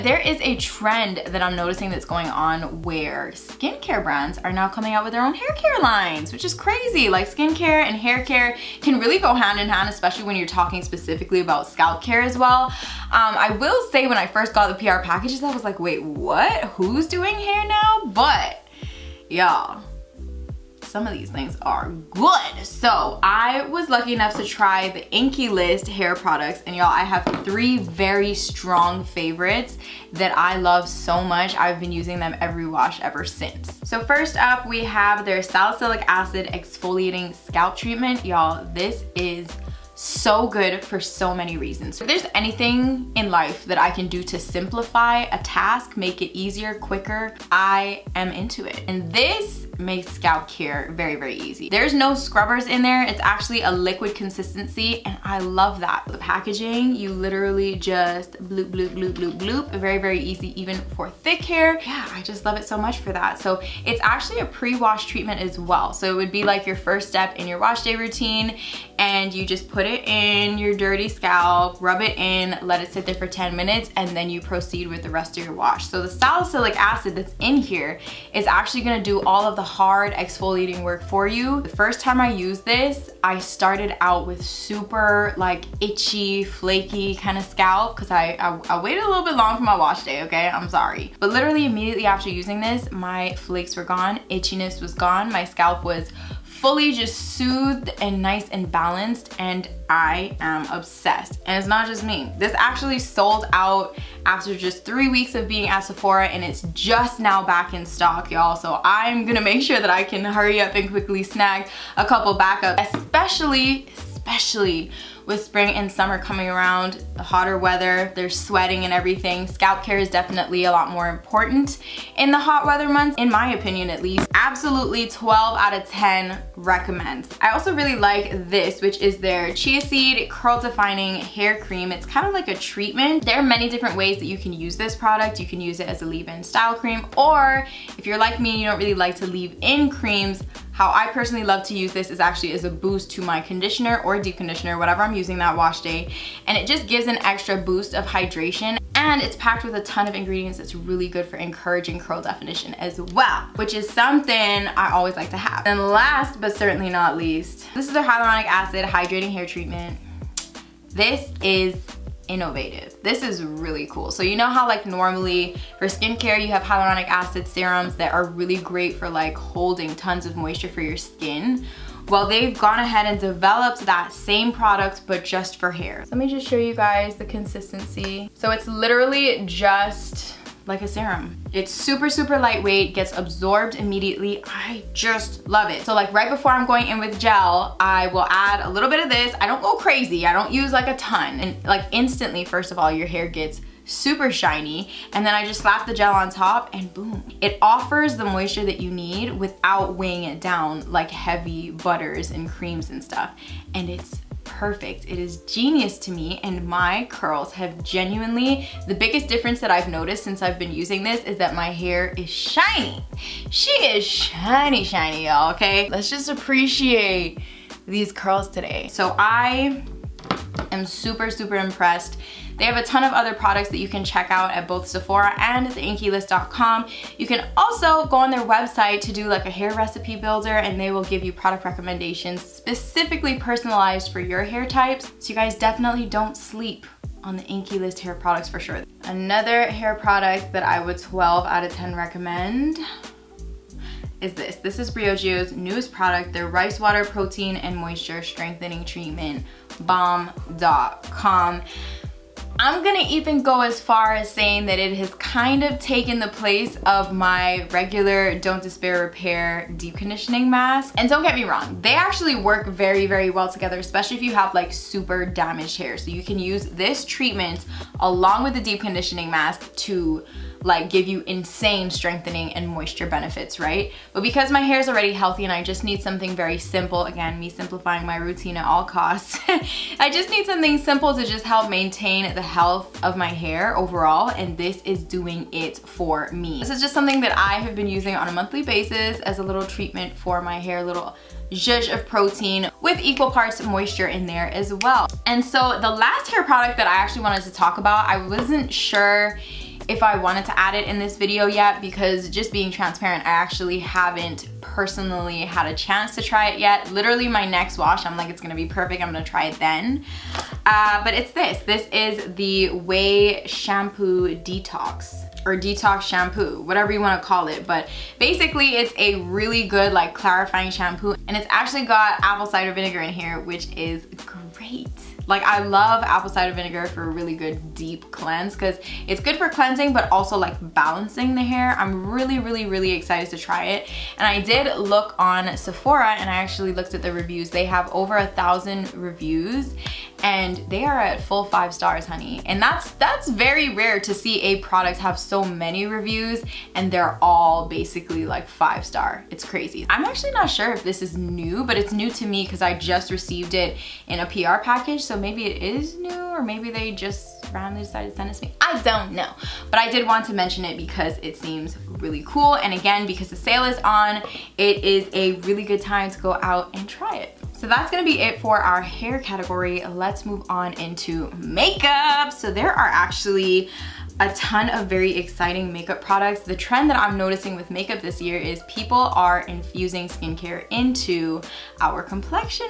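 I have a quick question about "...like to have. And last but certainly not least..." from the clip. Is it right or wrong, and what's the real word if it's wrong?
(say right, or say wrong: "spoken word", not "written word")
right.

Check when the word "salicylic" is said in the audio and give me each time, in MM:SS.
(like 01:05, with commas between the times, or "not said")
00:35, 01:16.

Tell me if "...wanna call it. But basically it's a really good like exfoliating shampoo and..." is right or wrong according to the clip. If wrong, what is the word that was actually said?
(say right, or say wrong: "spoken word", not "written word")
wrong: "clarifying", not "exfoliating".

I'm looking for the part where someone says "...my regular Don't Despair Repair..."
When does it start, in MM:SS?
04:17.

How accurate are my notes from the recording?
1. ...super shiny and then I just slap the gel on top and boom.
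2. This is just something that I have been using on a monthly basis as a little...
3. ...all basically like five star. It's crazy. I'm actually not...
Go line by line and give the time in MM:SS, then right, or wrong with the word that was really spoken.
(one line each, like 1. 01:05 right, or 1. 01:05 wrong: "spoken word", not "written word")
1. 03:13 right
2. 04:46 right
3. 05:47 right.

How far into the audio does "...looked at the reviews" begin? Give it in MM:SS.
05:36.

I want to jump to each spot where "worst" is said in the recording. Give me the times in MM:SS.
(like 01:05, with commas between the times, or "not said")
not said.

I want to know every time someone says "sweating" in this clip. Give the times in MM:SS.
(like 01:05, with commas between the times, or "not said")
01:58.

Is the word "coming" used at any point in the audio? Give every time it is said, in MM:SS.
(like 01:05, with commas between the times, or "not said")
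00:04, 01:56.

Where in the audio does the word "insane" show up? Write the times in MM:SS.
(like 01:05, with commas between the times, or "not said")
04:31.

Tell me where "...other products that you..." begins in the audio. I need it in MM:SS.
03:43.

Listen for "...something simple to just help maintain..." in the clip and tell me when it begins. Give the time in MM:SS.
04:40.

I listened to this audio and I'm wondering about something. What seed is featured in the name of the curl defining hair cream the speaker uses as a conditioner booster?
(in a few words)
Chia seed.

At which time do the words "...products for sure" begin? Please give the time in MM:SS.
03:58.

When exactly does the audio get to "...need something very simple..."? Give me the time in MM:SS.
04:35.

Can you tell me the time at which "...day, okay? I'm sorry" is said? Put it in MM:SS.
01:30.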